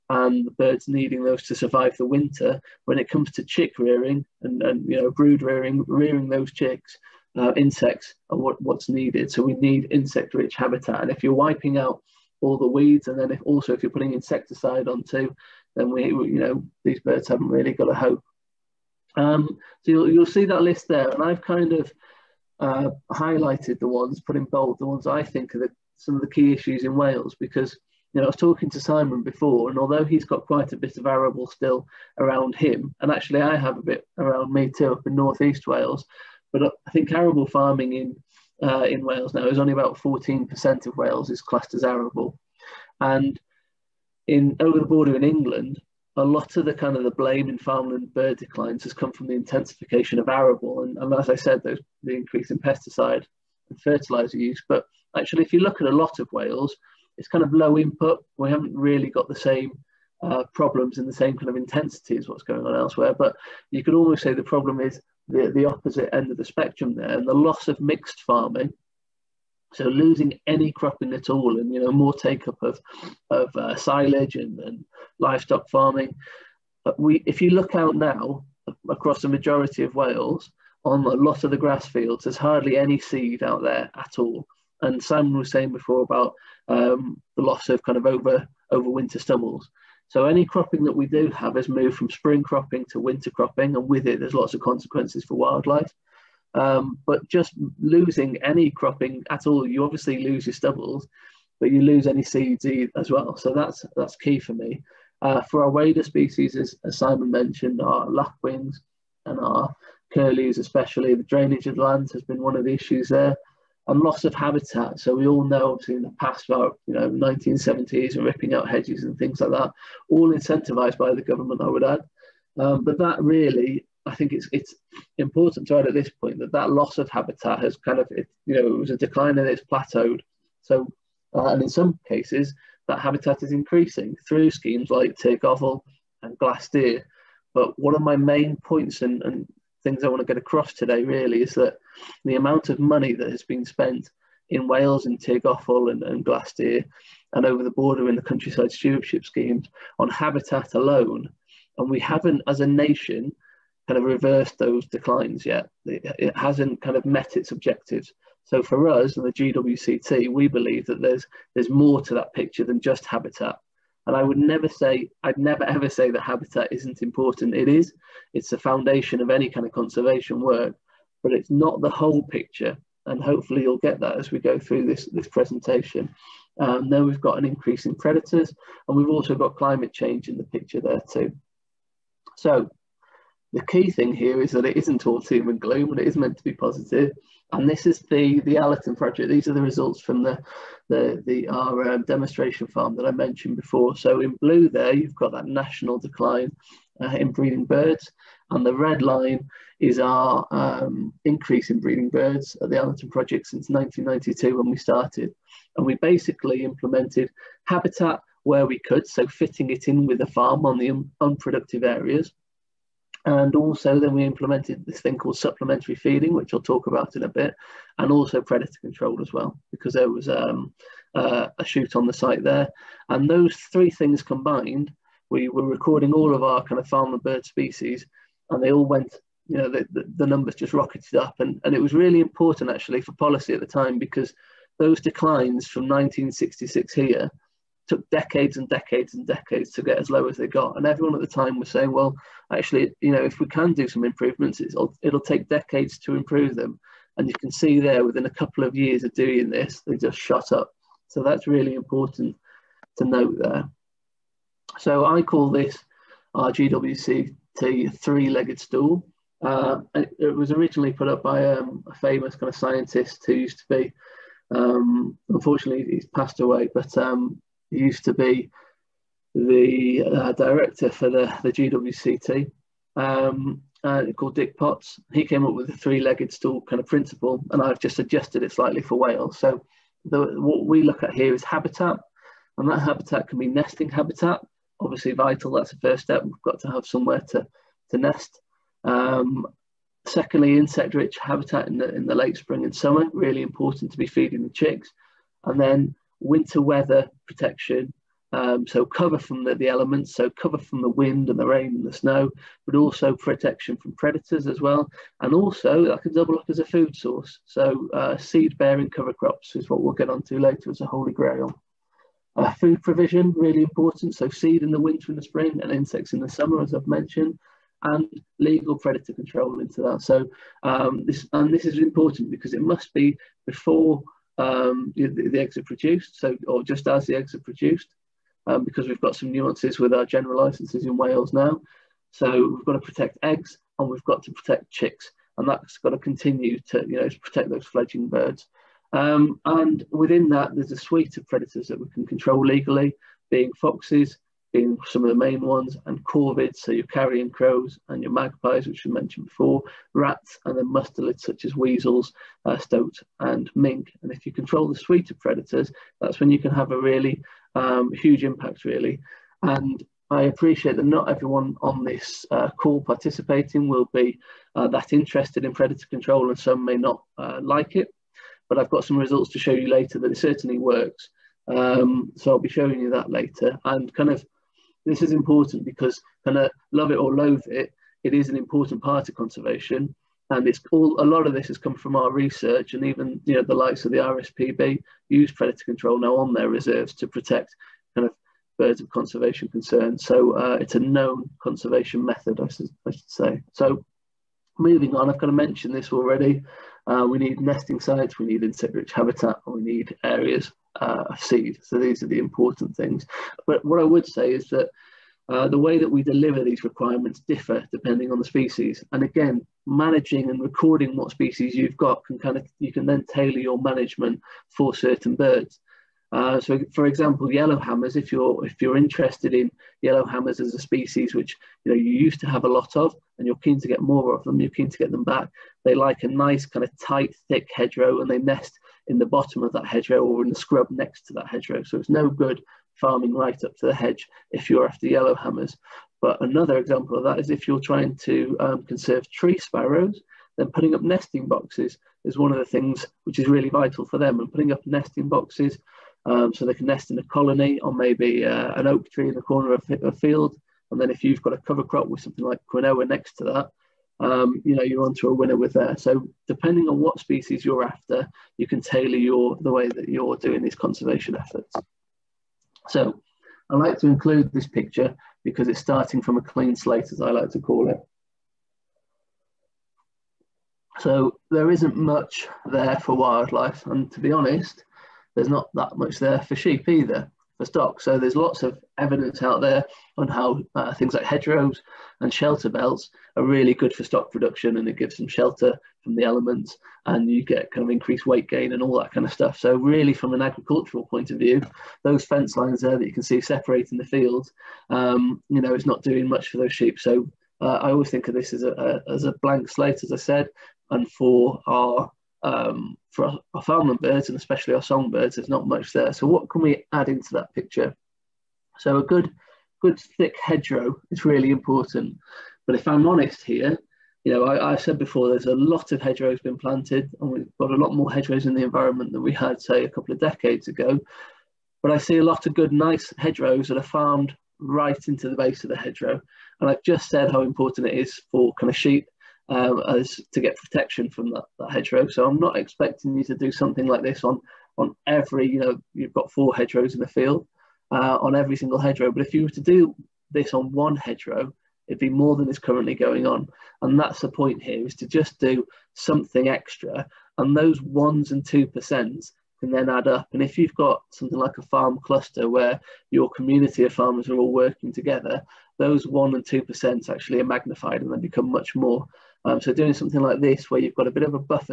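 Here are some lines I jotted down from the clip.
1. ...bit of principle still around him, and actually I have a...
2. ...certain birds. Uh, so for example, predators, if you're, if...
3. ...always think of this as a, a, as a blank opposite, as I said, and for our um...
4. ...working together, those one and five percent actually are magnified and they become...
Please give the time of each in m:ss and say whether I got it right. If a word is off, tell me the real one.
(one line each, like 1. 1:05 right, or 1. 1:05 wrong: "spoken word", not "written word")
1. 0:30 wrong: "arable", not "principle"
2. 6:54 wrong: "yellowhammers", not "predators"
3. 8:17 wrong: "slate", not "opposite"
4. 9:14 wrong: "two", not "five".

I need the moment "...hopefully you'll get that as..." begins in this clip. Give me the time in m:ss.
2:53.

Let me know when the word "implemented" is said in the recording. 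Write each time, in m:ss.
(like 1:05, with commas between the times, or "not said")
3:26, 3:34.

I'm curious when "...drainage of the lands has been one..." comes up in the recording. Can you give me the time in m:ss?
1:51.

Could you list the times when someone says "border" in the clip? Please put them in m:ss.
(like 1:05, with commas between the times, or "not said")
0:44, 2:27.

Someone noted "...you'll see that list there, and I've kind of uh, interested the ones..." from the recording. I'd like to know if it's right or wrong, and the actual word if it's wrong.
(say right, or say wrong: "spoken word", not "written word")
wrong: "highlighted", not "interested".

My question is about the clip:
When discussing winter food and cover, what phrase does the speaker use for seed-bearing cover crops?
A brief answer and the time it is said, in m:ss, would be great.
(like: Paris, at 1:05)
holy grail, at 5:10.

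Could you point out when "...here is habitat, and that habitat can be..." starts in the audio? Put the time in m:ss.
4:41.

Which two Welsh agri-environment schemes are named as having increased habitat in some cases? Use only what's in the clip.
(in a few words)
Tir Gofal and Glastir.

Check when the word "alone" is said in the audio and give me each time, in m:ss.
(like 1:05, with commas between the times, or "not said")
2:30.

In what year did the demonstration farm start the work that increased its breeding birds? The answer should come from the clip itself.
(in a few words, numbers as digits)
1992.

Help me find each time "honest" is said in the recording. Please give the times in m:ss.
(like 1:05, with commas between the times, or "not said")
7:54, 8:32.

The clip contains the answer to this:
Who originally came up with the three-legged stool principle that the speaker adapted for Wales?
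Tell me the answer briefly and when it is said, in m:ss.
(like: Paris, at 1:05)
Dick Potts, at 4:34.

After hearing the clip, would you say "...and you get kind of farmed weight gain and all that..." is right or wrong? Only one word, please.
wrong.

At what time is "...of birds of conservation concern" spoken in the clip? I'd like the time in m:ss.
6:28.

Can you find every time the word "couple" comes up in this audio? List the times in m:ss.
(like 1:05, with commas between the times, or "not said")
4:08, 8:39.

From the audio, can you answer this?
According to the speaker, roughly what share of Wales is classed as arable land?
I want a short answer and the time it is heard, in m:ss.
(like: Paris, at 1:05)
14%, at 0:39.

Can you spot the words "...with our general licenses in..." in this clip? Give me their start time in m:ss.
5:29.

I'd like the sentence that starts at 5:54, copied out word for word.
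And if you control the suite of predators, that's when you can have a really um, huge impact, really.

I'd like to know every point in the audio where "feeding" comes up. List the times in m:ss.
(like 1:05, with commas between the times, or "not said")
3:35, 4:54.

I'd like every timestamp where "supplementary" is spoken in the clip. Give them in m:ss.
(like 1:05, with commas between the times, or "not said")
3:35.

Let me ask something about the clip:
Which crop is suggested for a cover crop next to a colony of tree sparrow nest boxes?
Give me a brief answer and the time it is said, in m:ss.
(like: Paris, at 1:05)
quinoa, at 7:32.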